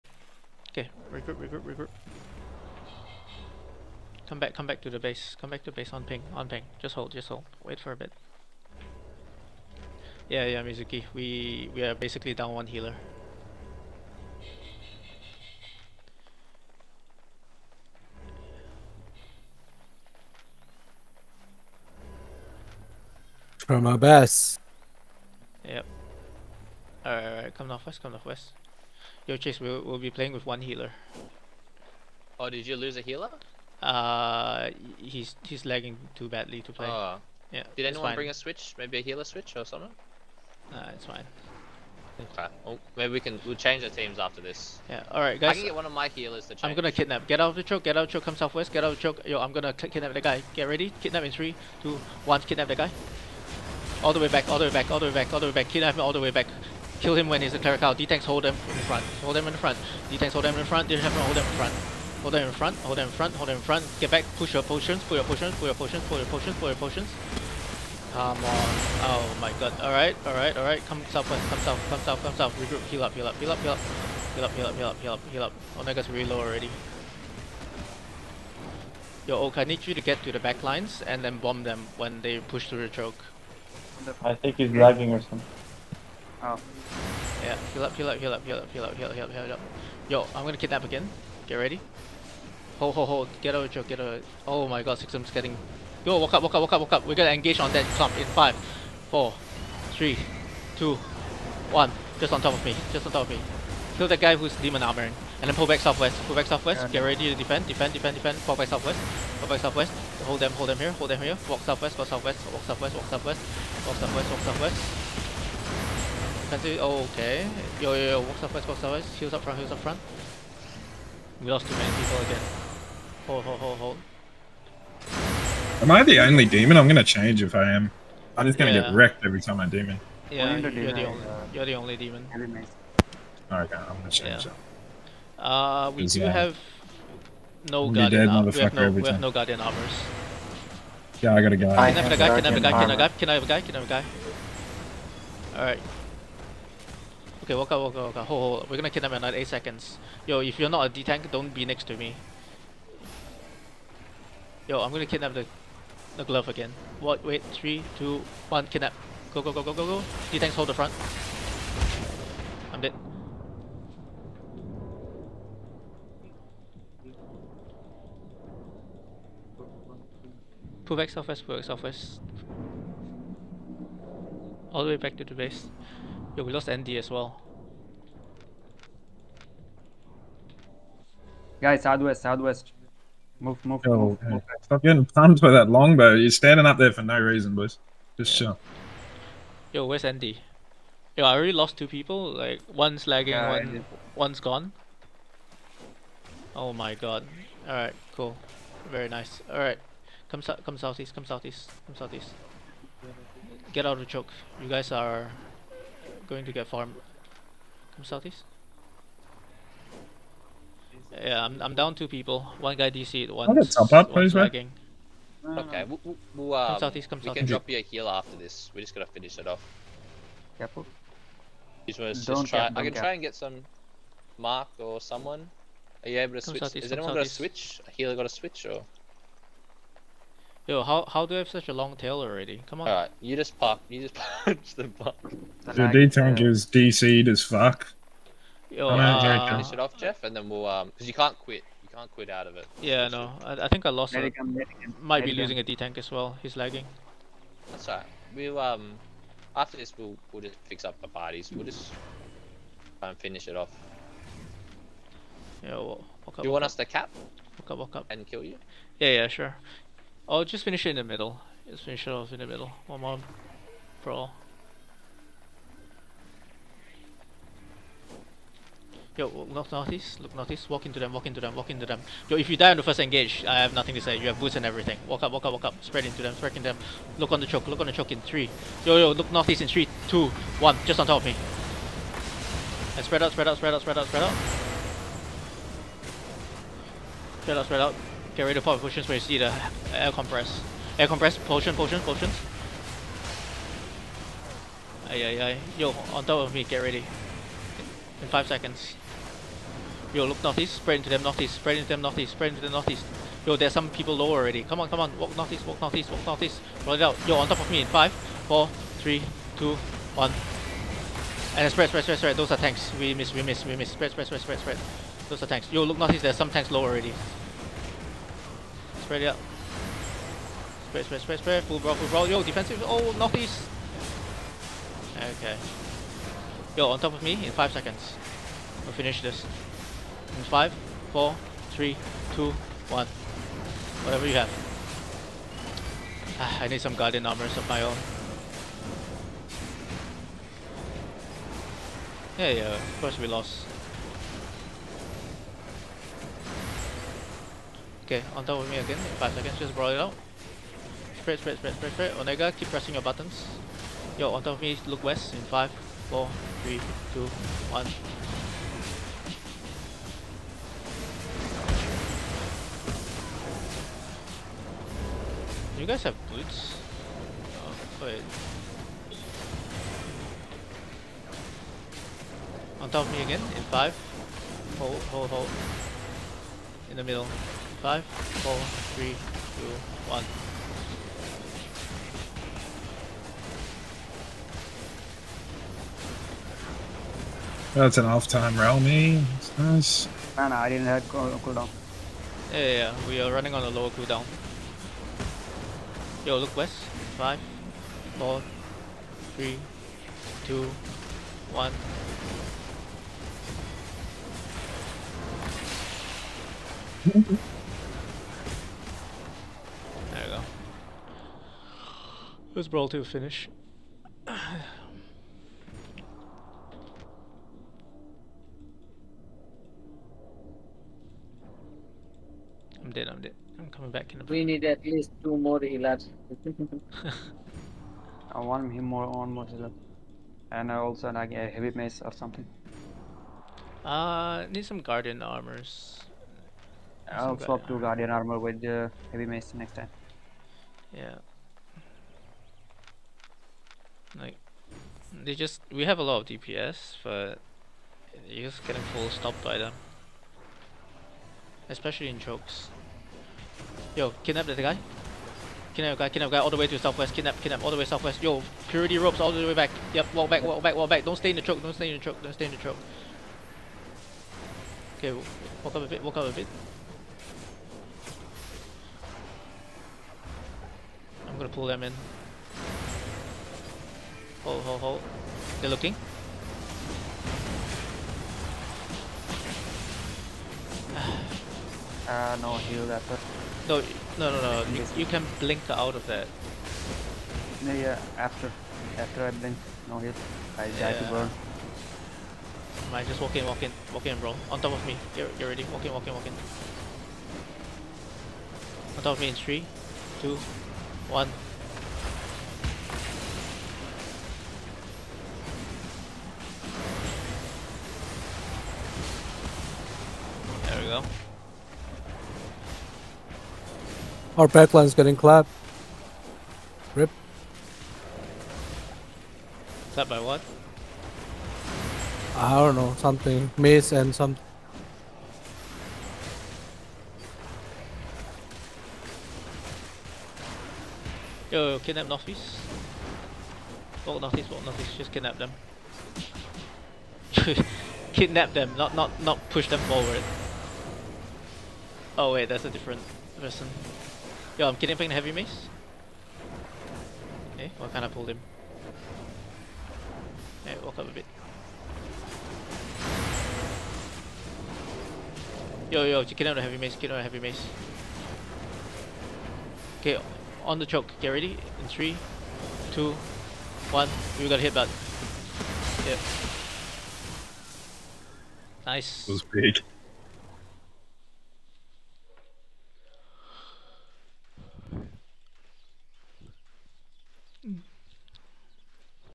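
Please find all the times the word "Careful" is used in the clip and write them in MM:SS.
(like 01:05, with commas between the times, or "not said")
03:40.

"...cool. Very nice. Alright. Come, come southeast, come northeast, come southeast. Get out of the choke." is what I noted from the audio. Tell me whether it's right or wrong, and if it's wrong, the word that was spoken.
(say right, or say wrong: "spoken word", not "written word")
wrong: "southeast", not "northeast".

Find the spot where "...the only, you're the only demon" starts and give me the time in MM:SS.
02:10.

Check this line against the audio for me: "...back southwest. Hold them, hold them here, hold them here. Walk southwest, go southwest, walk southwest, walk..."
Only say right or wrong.
right.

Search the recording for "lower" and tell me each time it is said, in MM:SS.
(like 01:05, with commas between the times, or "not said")
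05:04, 06:33.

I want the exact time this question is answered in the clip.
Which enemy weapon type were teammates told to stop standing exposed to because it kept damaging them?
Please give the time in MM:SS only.
03:05.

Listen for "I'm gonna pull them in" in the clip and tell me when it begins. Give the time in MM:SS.
07:51.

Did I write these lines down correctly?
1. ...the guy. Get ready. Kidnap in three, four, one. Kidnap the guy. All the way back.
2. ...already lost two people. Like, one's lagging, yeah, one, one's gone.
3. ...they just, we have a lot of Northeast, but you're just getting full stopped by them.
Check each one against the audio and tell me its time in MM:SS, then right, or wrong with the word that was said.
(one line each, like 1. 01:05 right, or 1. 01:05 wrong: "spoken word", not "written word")
1. 00:50 wrong: "two", not "four"
2. 03:11 right
3. 07:25 wrong: "DPS", not "Northeast".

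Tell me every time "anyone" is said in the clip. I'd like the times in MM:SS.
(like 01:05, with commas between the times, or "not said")
00:37, 03:46.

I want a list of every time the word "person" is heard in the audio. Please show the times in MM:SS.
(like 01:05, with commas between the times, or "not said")
08:03, 09:03.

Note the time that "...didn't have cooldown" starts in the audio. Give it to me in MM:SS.
06:30.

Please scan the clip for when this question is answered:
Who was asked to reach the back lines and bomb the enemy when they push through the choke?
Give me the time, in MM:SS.
01:19.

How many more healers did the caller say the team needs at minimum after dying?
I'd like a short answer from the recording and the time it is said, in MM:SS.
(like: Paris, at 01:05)
2, at 07:05.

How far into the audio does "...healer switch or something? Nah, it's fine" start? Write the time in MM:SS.
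00:39.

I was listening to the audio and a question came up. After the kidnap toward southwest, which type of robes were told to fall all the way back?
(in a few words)
Purity robes.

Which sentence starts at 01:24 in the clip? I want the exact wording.
I think he's lagging or something.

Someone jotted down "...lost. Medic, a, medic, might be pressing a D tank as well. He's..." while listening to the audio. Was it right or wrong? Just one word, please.
wrong.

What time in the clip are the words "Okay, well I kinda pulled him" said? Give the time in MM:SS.
09:07.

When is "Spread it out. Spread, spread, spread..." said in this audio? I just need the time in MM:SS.
05:19.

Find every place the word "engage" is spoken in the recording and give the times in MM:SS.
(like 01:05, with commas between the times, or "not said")
01:37, 04:32.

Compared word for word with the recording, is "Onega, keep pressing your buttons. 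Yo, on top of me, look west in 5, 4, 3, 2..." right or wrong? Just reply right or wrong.
right.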